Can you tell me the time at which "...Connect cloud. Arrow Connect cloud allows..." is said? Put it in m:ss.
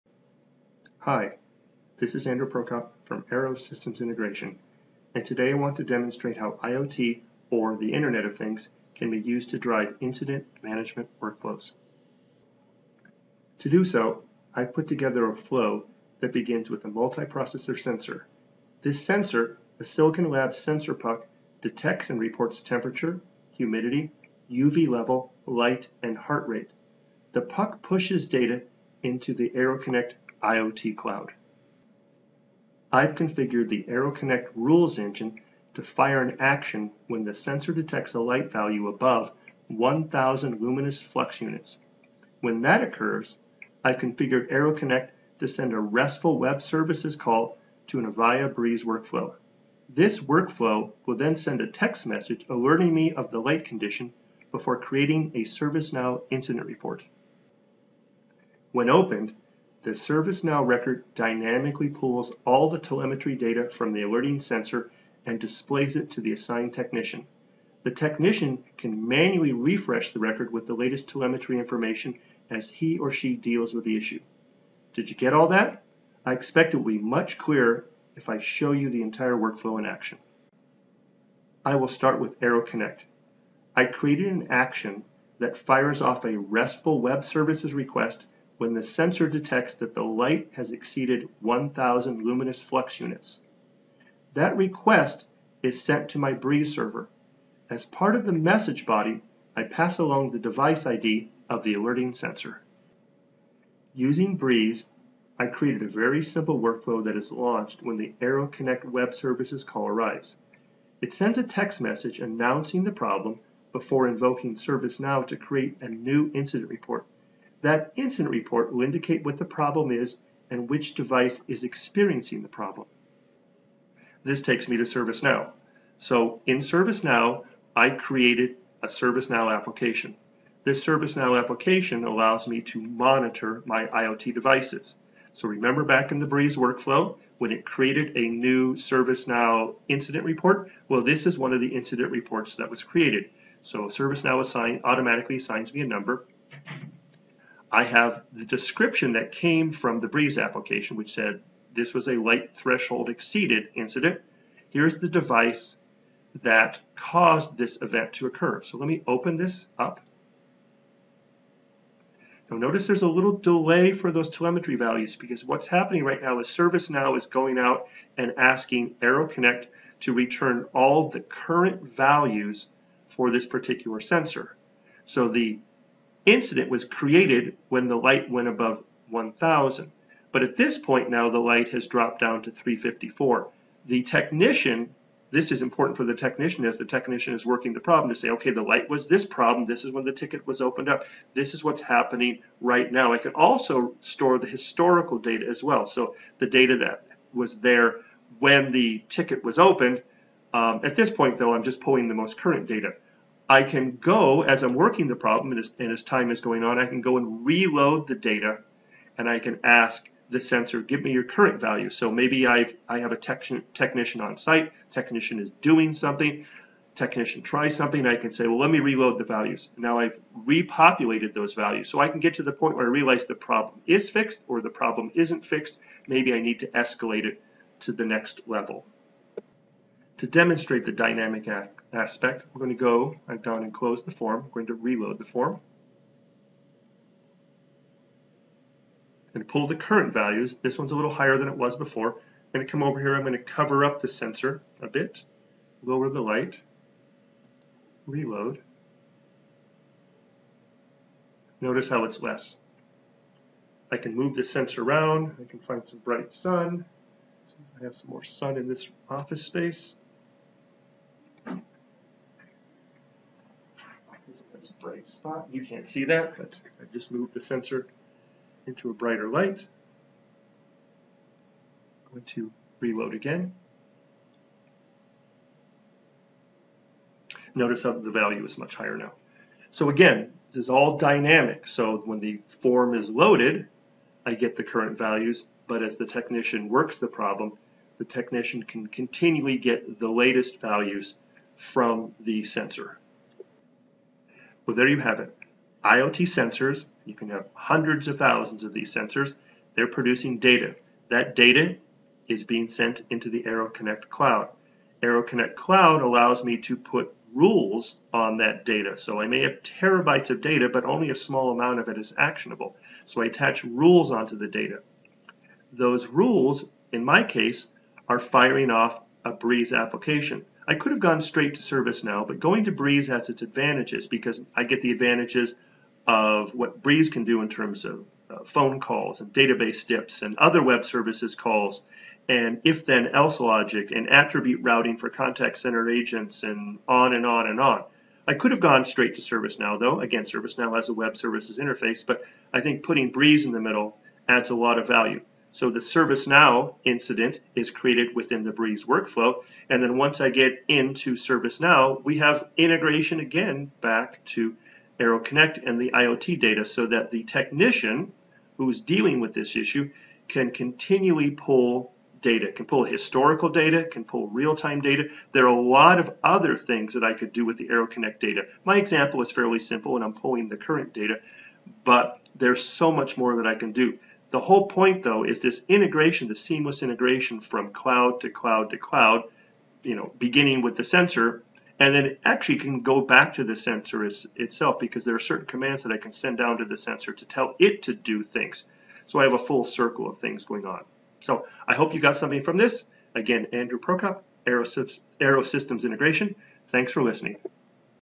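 5:03.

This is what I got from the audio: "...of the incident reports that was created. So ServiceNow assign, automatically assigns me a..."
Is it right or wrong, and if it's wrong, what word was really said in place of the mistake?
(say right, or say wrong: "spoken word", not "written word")
right.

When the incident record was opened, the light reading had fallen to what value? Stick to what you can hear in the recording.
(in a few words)
354.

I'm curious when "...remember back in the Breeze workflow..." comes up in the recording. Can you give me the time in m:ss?
2:15.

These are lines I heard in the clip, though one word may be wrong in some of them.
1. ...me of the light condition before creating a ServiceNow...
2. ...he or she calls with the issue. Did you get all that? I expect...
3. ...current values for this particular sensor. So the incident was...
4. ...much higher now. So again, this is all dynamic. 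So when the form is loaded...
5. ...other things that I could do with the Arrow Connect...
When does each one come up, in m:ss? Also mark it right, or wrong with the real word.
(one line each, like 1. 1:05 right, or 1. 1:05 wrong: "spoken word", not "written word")
1. 0:52 right
2. 1:12 wrong: "deals", not "calls"
3. 2:51 right
4. 4:38 right
5. 6:06 right.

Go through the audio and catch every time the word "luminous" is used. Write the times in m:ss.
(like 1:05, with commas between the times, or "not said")
0:40, 1:32.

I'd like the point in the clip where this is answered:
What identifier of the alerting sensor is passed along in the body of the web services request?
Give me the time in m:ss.
1:40.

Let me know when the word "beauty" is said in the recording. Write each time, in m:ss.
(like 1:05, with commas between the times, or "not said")
not said.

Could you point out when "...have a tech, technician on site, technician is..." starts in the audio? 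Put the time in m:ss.
3:32.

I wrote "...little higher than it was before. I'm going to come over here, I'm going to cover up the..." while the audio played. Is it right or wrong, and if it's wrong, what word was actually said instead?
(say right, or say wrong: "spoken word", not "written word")
right.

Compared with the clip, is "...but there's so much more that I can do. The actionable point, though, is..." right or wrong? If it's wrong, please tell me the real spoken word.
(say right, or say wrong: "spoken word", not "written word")
wrong: "whole", not "actionable".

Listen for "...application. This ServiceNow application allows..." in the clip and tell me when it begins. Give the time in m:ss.
2:09.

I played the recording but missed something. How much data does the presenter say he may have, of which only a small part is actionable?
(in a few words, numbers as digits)
terabytes.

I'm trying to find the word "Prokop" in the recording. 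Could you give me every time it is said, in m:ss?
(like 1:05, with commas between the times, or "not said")
0:02, 6:33.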